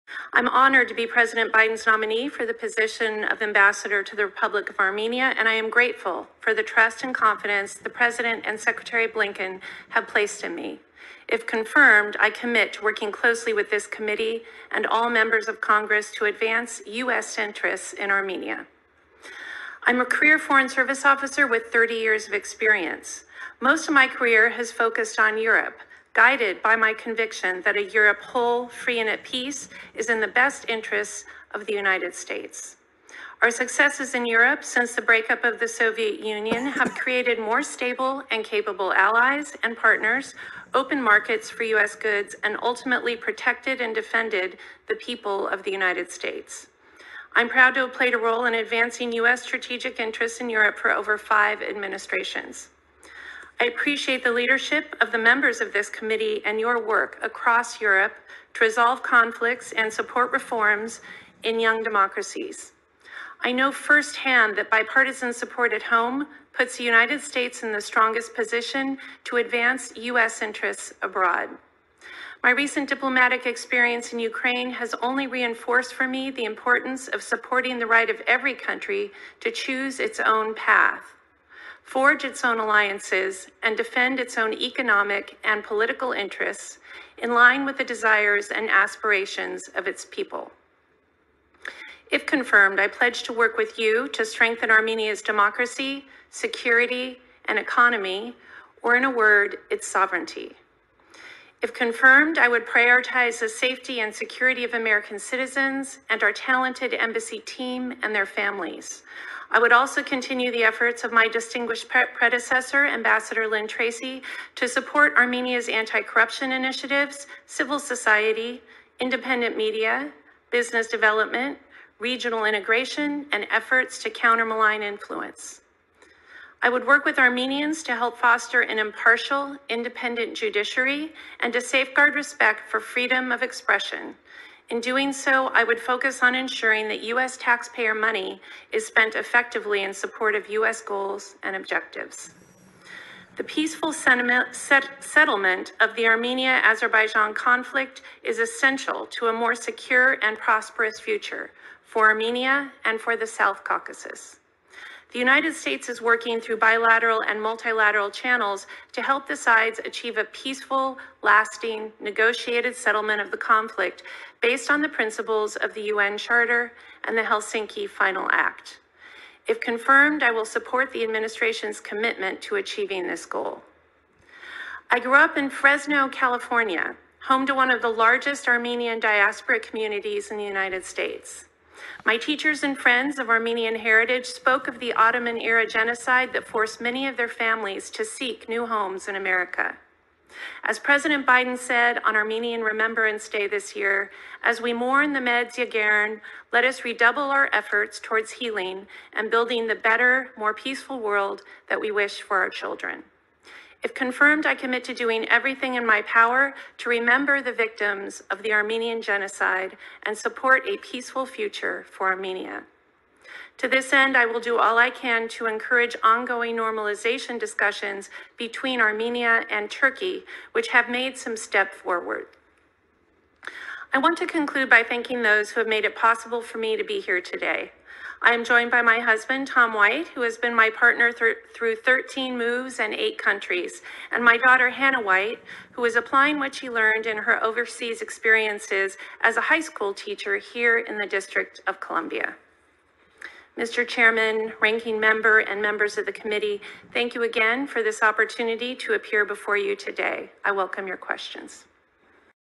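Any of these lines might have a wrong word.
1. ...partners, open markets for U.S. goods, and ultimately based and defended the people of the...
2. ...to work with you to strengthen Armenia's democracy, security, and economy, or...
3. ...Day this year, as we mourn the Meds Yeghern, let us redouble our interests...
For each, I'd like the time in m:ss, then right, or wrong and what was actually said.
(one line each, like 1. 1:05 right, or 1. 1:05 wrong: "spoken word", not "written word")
1. 0:39 wrong: "protected", not "based"
2. 1:33 right
3. 3:13 wrong: "efforts", not "interests".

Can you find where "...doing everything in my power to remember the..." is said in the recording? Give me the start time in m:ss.
3:24.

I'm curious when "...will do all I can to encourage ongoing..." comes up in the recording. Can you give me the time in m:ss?
3:34.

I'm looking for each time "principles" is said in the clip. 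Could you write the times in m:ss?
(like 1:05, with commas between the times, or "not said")
2:44.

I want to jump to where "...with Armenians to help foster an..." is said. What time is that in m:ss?
2:07.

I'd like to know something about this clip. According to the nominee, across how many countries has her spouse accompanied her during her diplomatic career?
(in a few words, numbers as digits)
8.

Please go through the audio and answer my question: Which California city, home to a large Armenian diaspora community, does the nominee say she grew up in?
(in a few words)
Fresno.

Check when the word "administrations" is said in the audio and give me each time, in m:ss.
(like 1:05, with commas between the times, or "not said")
0:51, 2:51.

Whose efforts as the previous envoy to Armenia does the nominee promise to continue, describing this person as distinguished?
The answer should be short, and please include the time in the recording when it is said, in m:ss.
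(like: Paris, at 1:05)
Lynn Tracy, at 1:53.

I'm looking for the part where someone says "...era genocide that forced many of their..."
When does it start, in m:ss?
3:05.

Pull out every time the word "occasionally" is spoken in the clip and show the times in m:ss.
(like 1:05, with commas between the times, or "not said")
not said.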